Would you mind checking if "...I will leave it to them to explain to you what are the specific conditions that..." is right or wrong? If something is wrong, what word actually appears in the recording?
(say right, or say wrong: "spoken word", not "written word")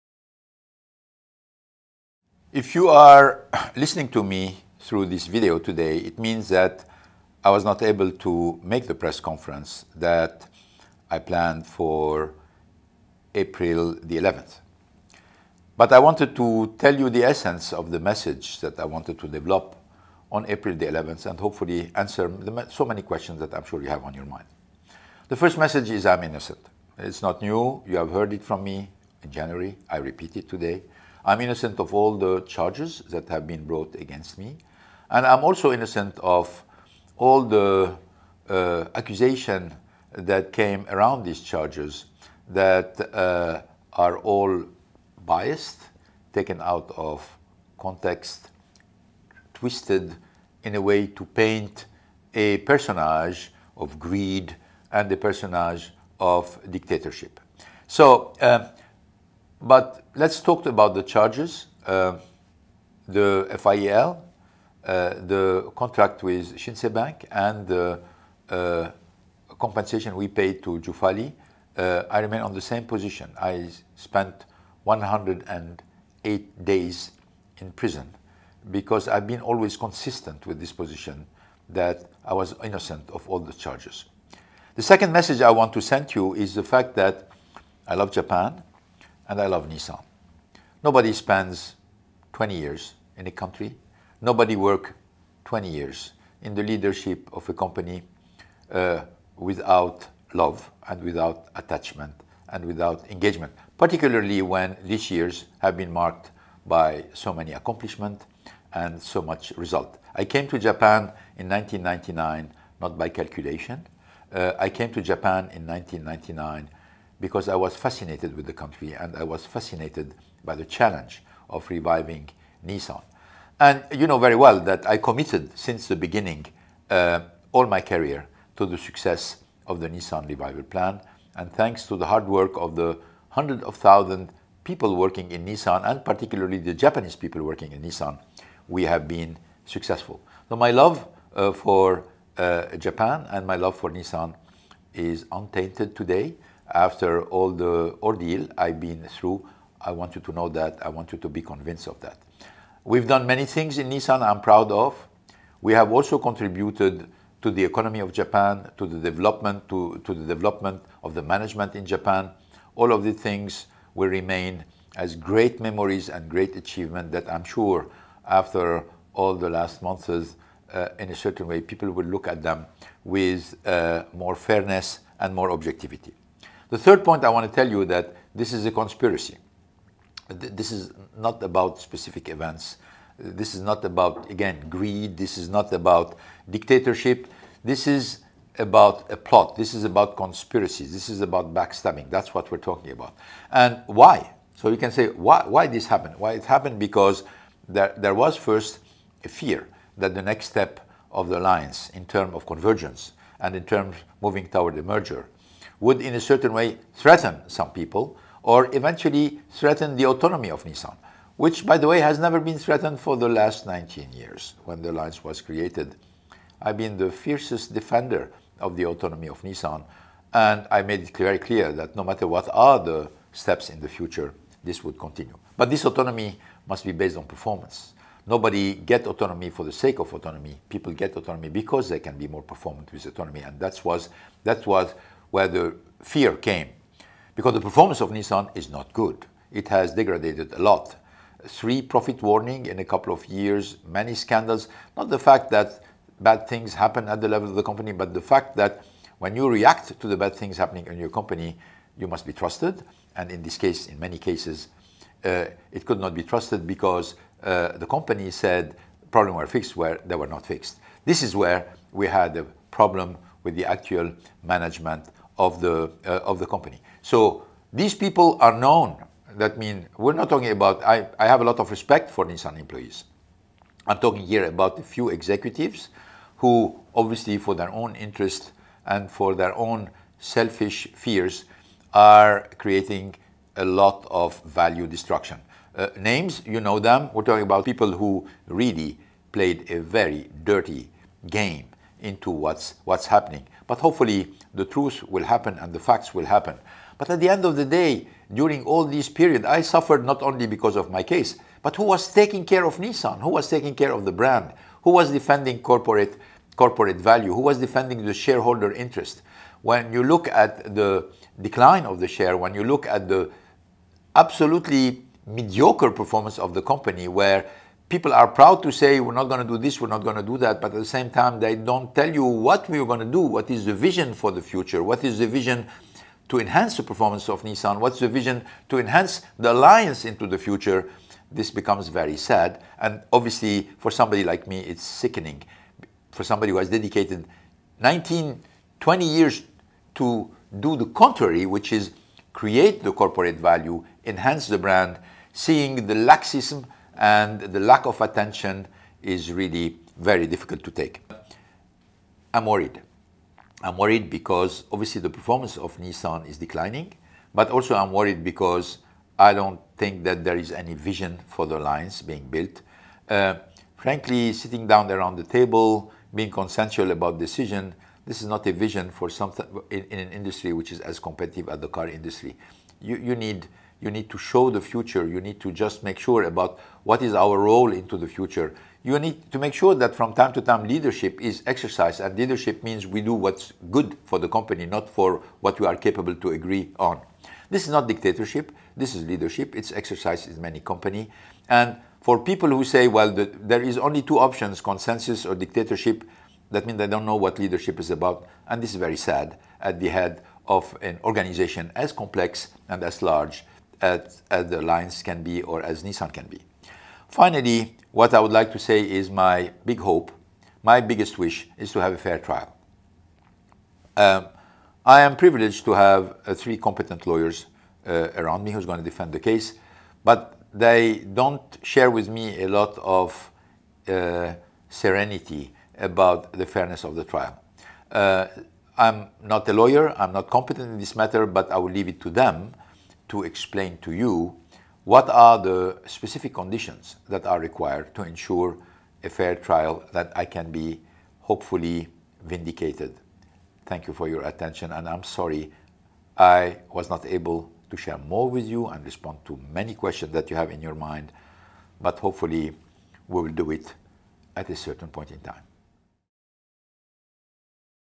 right.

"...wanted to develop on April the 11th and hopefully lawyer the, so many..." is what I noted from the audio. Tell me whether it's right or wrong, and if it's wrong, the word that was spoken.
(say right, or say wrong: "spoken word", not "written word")
wrong: "answer", not "lawyer".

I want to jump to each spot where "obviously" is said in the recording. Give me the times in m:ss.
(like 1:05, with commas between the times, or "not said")
4:36, 5:33, 5:54.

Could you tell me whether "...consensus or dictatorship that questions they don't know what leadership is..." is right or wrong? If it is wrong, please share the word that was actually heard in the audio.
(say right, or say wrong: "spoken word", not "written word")
wrong: "means", not "questions".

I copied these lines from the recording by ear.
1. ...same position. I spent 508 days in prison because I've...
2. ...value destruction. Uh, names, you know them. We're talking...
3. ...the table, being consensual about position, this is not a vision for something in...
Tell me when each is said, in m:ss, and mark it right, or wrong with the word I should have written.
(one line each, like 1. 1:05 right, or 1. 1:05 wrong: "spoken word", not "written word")
1. 1:12 wrong: "108", not "508"
2. 4:44 right
3. 6:05 wrong: "decision", not "position".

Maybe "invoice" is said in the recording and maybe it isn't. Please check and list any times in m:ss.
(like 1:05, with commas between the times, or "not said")
not said.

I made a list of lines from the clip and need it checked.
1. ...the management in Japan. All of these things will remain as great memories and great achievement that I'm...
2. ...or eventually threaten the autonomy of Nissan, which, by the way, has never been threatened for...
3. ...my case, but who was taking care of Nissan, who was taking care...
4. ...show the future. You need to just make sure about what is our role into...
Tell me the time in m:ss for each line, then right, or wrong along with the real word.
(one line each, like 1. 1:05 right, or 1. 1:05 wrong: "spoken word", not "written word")
1. 2:41 right
2. 3:28 right
3. 5:00 right
4. 6:14 right.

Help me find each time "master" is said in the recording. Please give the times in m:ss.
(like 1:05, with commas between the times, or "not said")
not said.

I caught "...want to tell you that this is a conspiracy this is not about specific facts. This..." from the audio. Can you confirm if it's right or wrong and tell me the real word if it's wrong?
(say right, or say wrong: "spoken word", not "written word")
wrong: "events", not "facts".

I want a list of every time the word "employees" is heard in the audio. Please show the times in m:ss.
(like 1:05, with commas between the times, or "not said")
4:32.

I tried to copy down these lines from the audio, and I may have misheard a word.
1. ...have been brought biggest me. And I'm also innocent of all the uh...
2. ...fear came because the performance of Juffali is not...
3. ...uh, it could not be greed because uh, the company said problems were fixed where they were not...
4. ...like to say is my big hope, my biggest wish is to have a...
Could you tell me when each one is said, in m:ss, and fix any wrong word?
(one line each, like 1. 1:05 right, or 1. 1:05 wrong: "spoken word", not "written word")
1. 0:33 wrong: "against", not "biggest"
2. 3:56 wrong: "Nissan", not "Juffali"
3. 4:15 wrong: "trusted", not "greed"
4. 6:48 right.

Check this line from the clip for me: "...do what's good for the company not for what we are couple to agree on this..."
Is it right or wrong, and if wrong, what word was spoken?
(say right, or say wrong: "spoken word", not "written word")
wrong: "capable", not "couple".